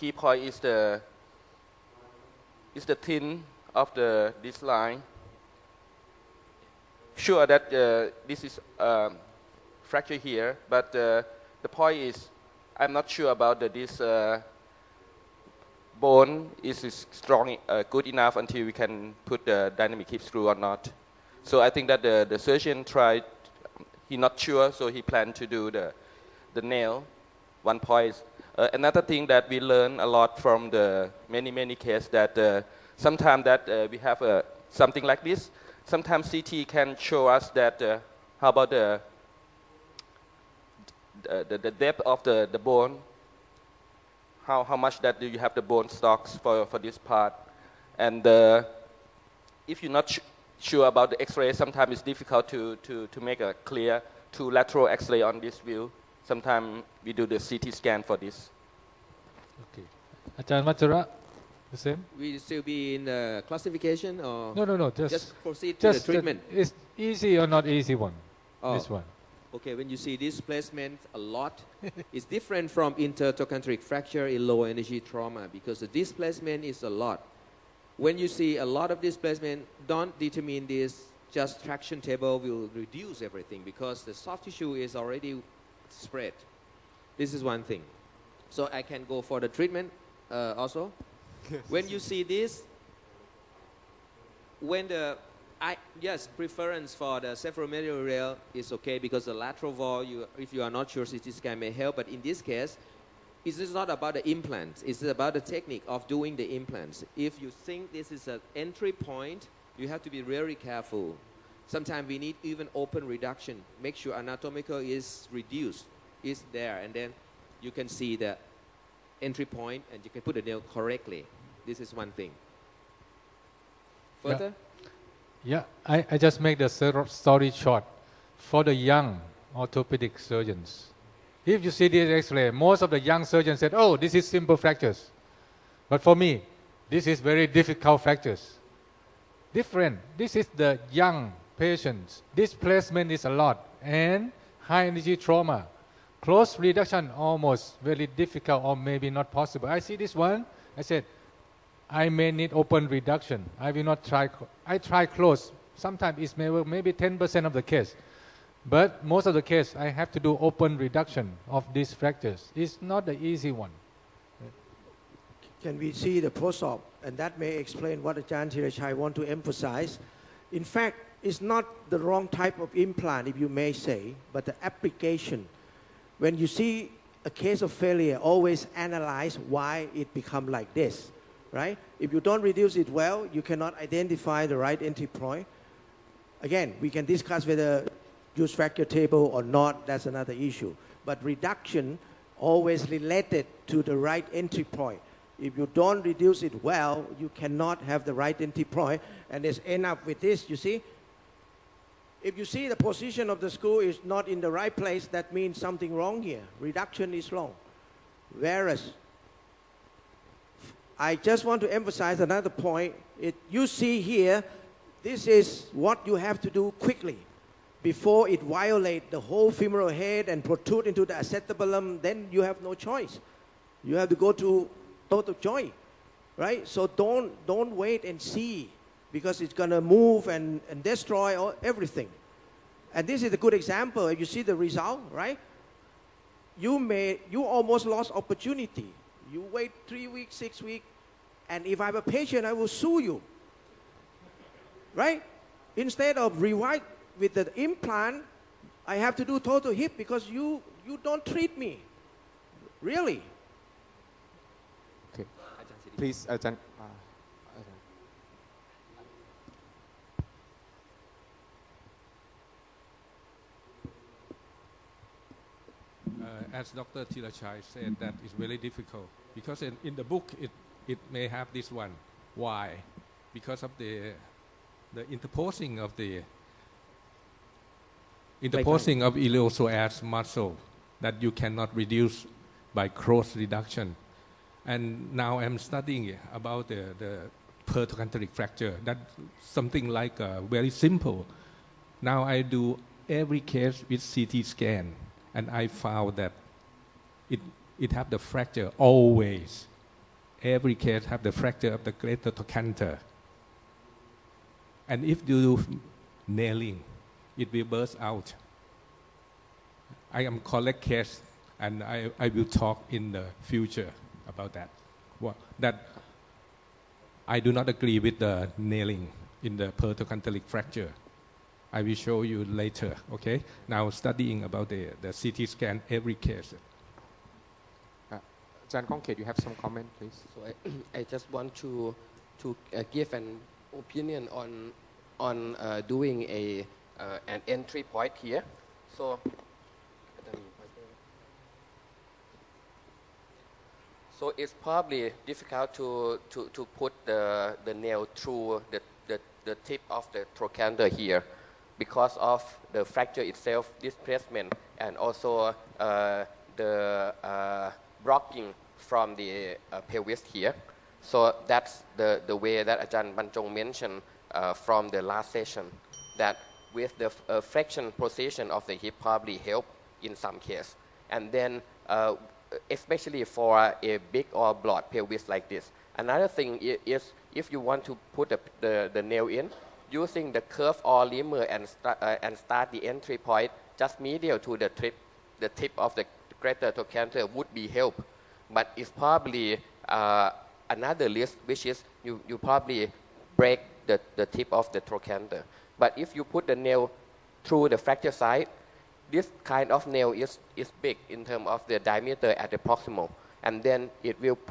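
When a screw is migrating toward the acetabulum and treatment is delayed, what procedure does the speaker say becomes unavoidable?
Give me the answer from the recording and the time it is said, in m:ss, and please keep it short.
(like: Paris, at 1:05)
total joint, at 3:45.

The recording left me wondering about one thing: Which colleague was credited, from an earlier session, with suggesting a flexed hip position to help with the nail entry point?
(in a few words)
Ajahn Banjong.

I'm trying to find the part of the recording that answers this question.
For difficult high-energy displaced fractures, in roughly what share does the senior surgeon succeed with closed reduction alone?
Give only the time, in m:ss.
2:36.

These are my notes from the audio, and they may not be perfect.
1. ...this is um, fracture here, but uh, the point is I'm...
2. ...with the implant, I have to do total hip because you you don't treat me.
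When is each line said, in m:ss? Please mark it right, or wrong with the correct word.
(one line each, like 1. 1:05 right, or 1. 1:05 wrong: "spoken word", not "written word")
1. 0:08 right
2. 4:07 right.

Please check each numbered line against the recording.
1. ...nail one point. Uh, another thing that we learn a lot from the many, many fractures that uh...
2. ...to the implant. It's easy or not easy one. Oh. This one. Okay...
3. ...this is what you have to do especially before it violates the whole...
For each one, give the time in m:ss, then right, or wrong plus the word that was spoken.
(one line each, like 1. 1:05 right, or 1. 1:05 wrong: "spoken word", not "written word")
1. 0:26 wrong: "cases", not "fractures"
2. 1:06 wrong: "treatment", not "implant"
3. 3:35 wrong: "quickly", not "especially".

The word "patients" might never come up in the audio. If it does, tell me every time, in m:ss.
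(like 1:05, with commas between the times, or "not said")
2:21, 4:02.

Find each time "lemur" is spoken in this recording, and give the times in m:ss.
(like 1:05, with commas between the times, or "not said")
6:21.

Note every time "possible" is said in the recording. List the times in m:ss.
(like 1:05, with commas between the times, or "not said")
2:29.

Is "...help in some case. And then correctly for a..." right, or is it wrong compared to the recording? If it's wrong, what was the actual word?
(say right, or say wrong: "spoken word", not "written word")
wrong: "especially", not "correctly".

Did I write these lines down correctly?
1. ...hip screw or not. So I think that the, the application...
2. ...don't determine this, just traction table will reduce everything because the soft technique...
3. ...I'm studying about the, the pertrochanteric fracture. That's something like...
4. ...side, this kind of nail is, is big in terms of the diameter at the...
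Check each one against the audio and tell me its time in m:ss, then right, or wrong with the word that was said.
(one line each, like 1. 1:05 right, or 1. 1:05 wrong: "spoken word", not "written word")
1. 0:20 wrong: "surgeon", not "application"
2. 1:19 wrong: "tissue", not "technique"
3. 4:45 right
4. 6:38 right.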